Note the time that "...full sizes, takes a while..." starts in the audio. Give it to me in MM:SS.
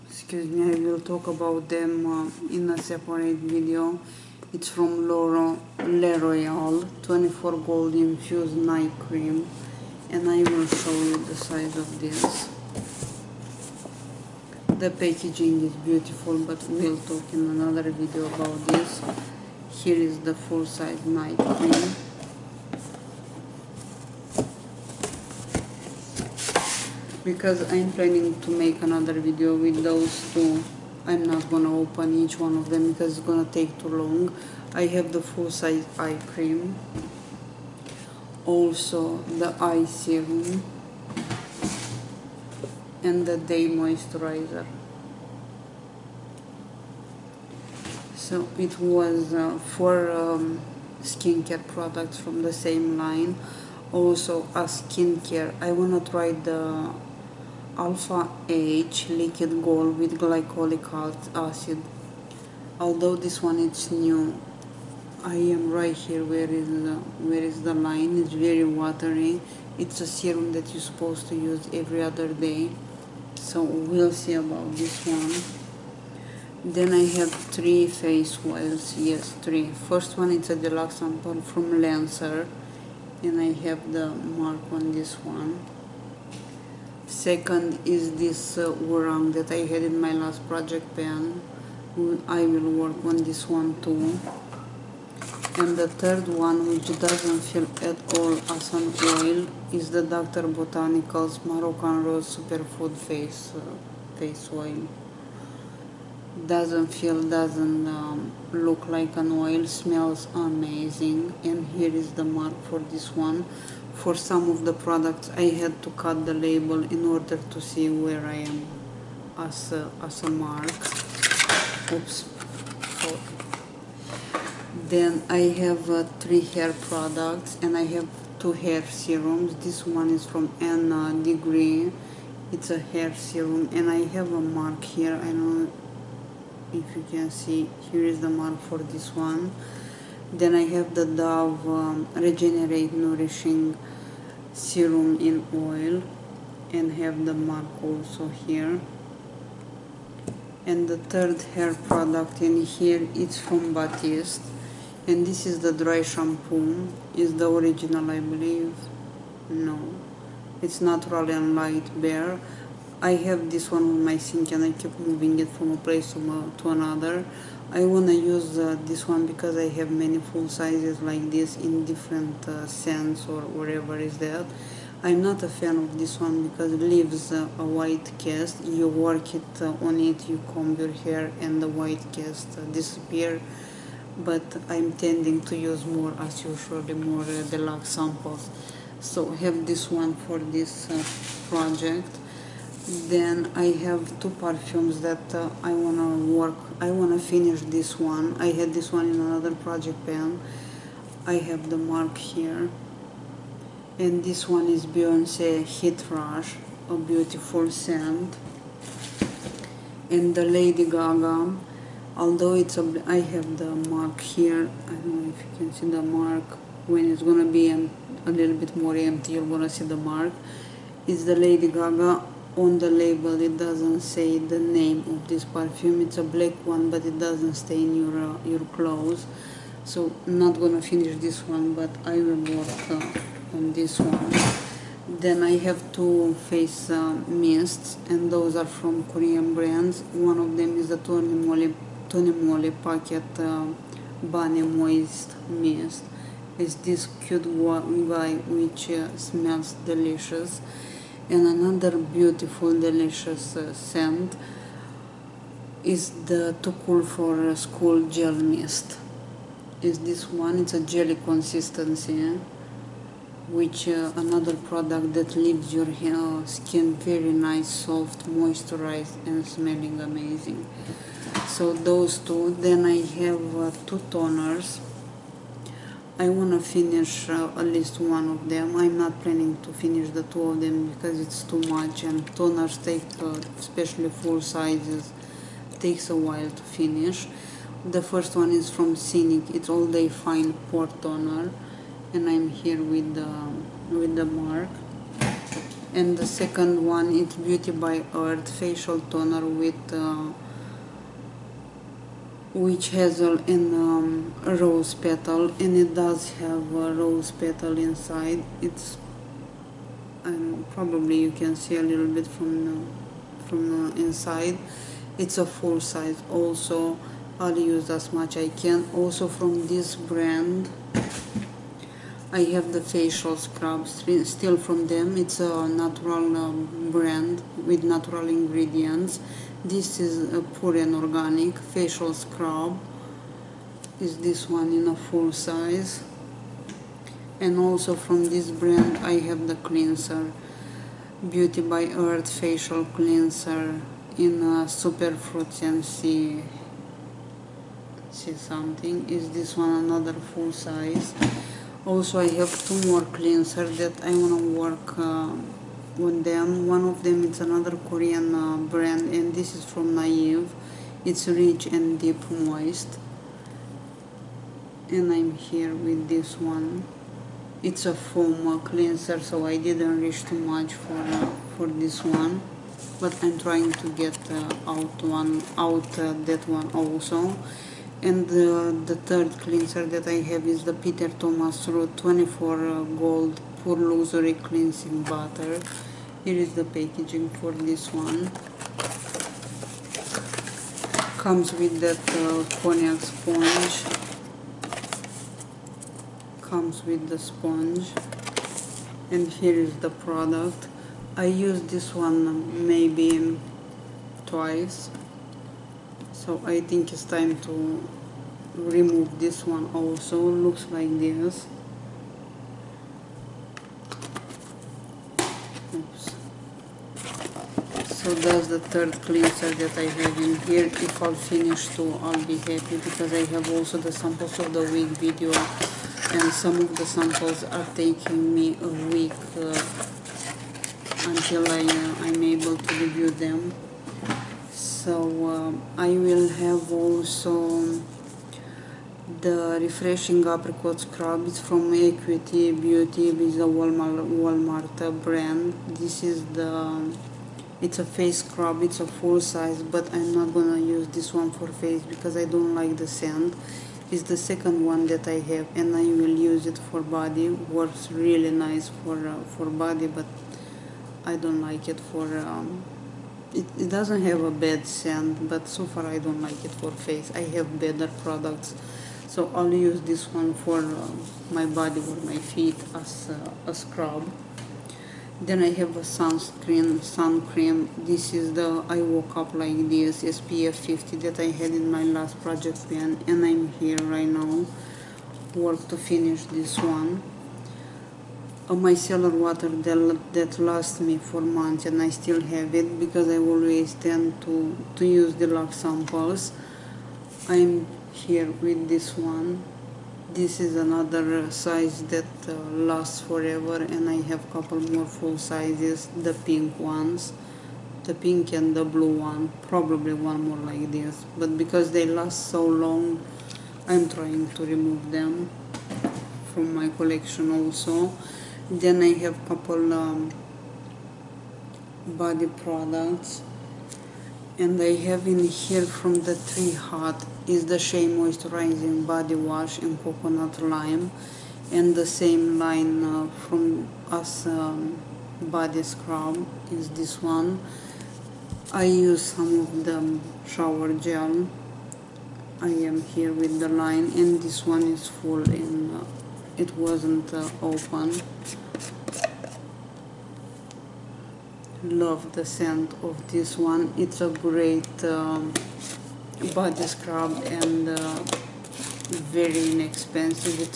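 04:44.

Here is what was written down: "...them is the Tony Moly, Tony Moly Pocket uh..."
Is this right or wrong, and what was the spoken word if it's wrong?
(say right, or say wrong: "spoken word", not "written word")
right.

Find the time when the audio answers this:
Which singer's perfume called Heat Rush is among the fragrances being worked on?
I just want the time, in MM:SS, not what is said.
03:24.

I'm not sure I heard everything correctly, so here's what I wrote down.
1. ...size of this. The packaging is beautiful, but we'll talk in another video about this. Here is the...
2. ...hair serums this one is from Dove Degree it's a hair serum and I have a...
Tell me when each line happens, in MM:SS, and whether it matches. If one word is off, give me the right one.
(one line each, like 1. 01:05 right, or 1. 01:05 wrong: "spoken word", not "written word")
1. 00:11 right
2. 02:08 wrong: "Anna", not "Dove".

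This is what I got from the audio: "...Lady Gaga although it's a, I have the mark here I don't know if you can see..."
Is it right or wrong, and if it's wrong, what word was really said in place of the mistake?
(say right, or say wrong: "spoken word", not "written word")
right.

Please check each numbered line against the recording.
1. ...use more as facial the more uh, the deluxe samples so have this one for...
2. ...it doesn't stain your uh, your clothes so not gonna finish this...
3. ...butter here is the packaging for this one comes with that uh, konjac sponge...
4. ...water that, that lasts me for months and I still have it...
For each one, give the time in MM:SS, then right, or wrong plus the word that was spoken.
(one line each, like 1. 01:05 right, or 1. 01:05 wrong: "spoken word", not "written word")
1. 03:05 wrong: "usual", not "facial"
2. 03:47 right
3. 06:25 right
4. 08:09 right.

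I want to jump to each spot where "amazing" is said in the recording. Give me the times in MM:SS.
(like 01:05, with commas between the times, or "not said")
01:50, 04:30.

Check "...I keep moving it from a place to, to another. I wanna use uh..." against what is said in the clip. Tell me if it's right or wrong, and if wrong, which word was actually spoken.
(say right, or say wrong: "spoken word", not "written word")
right.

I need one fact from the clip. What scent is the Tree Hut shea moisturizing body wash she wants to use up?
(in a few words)
Coconut Lime.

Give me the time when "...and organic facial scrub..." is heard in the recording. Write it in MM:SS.
05:30.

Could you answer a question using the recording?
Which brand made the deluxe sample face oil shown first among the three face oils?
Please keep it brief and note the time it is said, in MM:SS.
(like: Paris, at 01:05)
Lancer, at 01:21.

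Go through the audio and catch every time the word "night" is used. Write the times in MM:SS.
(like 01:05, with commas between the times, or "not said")
00:08, 00:21.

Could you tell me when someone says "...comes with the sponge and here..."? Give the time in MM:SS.
06:36.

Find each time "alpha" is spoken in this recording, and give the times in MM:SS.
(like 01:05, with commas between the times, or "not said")
00:57.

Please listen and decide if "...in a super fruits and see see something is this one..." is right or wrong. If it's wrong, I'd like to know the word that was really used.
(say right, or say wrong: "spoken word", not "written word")
right.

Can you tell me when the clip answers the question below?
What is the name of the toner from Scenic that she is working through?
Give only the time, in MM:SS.
04:49.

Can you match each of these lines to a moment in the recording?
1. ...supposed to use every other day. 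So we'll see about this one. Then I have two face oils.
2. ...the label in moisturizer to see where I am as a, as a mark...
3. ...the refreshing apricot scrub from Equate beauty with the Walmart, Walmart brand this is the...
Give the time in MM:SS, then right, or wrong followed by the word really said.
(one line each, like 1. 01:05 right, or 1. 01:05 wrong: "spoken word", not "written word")
1. 01:10 wrong: "three", not "two"
2. 01:56 wrong: "order", not "moisturizer"
3. 07:19 right.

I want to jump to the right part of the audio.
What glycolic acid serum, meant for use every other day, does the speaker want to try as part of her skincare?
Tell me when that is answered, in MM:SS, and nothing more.
00:59.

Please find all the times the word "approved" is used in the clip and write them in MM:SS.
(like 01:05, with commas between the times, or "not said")
not said.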